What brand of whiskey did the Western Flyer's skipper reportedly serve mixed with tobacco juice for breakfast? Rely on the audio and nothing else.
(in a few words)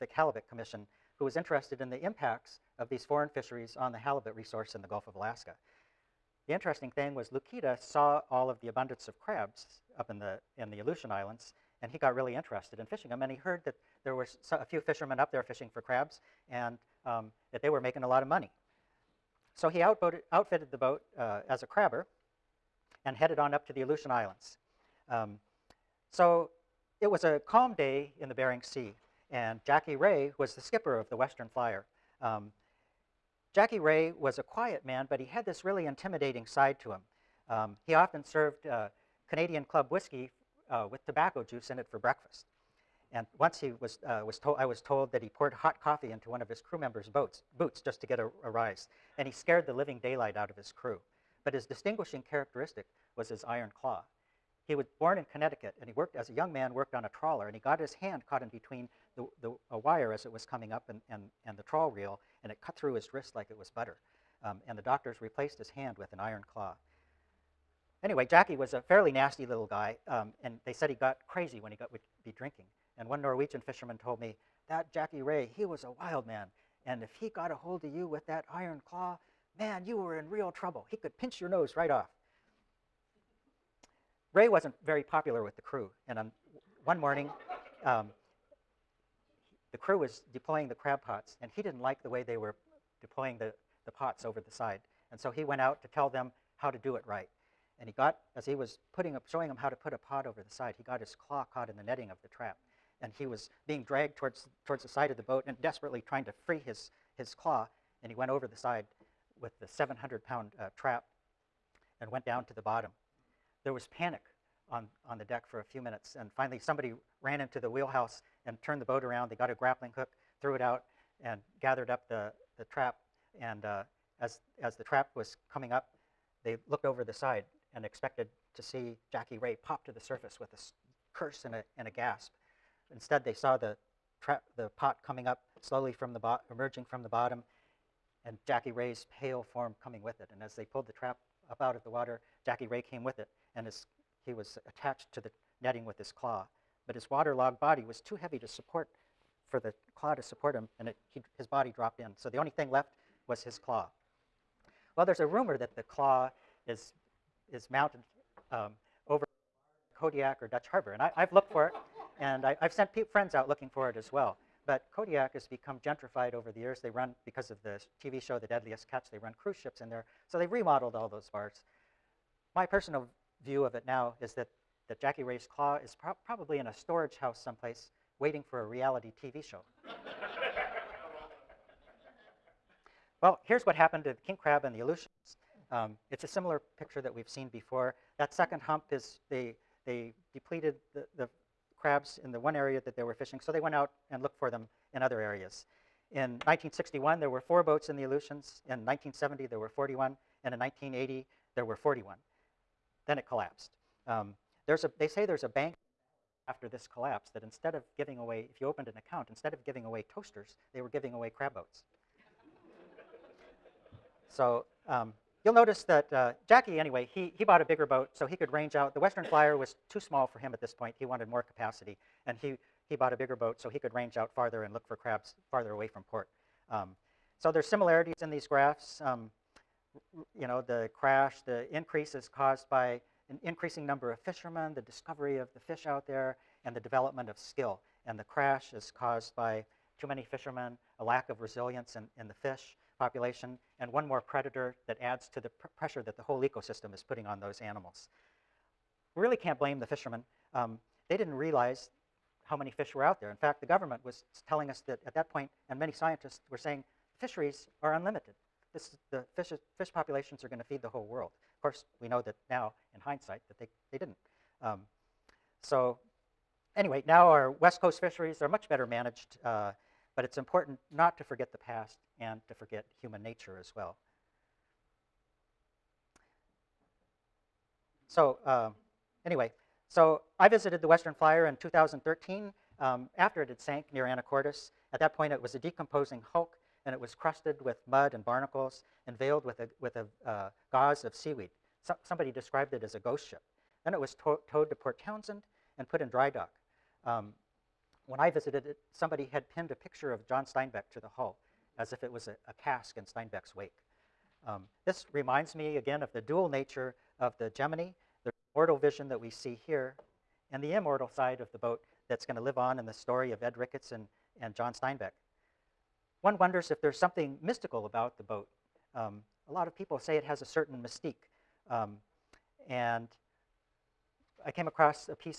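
Canadian Club.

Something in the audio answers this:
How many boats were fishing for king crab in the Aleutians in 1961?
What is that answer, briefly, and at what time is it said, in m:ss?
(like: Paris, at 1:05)
4, at 3:17.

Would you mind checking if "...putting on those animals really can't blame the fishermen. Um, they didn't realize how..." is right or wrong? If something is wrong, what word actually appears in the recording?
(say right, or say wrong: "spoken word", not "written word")
right.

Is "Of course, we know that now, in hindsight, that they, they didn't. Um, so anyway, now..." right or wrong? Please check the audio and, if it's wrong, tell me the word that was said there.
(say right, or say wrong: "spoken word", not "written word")
right.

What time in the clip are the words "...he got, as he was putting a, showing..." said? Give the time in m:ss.
1:37.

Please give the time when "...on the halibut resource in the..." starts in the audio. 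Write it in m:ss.
0:03.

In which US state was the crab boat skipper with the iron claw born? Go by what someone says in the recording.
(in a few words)
Connecticut.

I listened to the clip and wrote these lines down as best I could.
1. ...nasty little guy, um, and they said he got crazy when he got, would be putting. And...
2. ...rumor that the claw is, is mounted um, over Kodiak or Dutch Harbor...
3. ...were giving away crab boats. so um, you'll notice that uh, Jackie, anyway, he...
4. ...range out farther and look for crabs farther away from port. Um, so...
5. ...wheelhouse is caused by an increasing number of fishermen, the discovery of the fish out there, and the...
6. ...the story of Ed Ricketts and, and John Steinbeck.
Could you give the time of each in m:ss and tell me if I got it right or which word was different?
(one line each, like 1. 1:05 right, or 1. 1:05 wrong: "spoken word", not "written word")
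1. 1:09 wrong: "drinking", not "putting"
2. 2:35 right
3. 3:30 right
4. 3:43 right
5. 3:51 wrong: "increase", not "wheelhouse"
6. 5:12 right.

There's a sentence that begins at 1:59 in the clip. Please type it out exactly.
They got a grappling hook, threw it out, and gathered up the, the trap.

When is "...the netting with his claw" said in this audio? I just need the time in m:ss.
2:25.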